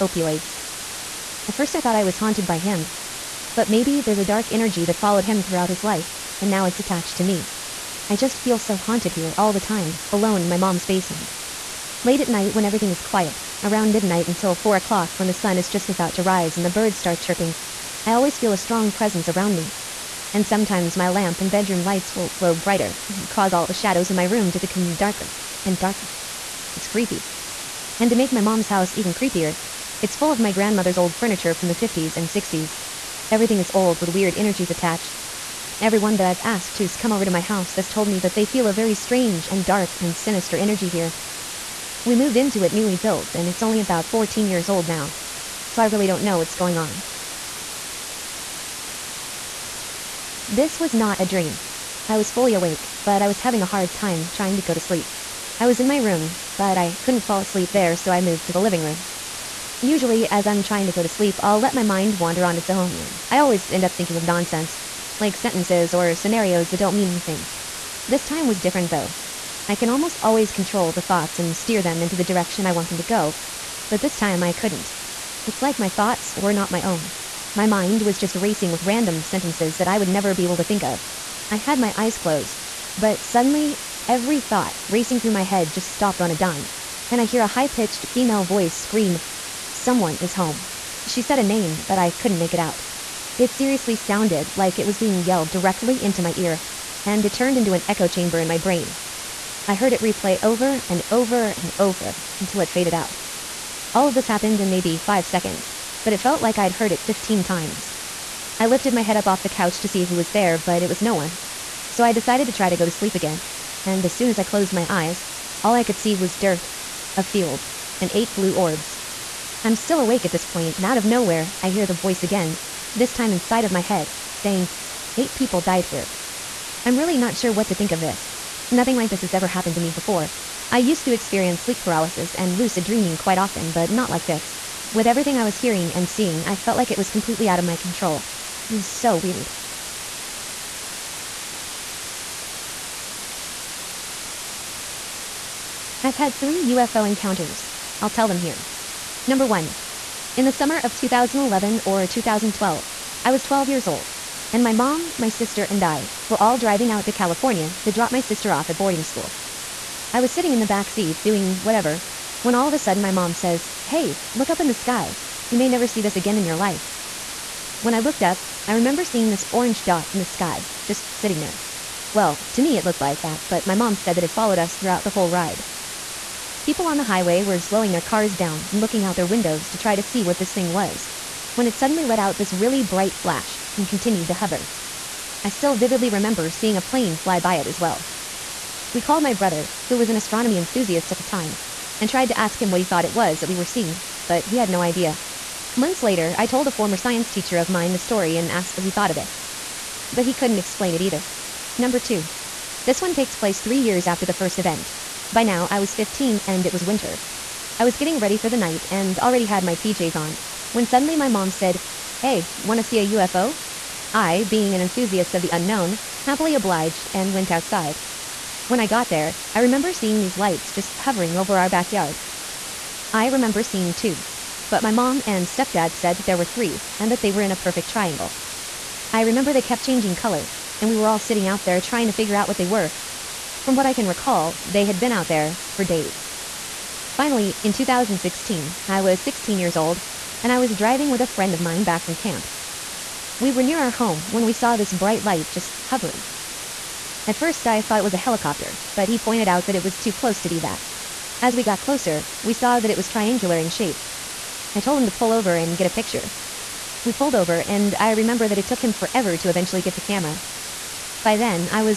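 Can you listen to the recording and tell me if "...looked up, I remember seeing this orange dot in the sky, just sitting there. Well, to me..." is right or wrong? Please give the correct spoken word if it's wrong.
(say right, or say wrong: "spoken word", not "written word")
right.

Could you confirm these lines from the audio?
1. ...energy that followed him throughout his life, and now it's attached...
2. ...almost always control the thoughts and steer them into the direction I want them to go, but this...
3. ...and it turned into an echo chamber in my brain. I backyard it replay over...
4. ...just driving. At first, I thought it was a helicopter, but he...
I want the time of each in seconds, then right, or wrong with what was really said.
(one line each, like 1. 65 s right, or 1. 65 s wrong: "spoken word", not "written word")
1. 4 s right
2. 69 s right
3. 97 s wrong: "heard", not "backyard"
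4. 245 s wrong: "hovering", not "driving".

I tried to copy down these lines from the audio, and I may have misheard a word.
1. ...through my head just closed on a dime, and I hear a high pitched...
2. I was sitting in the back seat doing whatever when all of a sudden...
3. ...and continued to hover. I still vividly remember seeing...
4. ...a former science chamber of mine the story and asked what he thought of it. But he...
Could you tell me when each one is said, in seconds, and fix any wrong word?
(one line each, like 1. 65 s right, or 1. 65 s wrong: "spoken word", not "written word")
1. 85 s wrong: "stopped", not "closed"
2. 160 s right
3. 183 s right
4. 196 s wrong: "teacher", not "chamber".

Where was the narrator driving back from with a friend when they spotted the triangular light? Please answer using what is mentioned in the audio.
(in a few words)
camp.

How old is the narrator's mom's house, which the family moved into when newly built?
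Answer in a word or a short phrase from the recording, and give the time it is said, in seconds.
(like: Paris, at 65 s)
14, at 44 s.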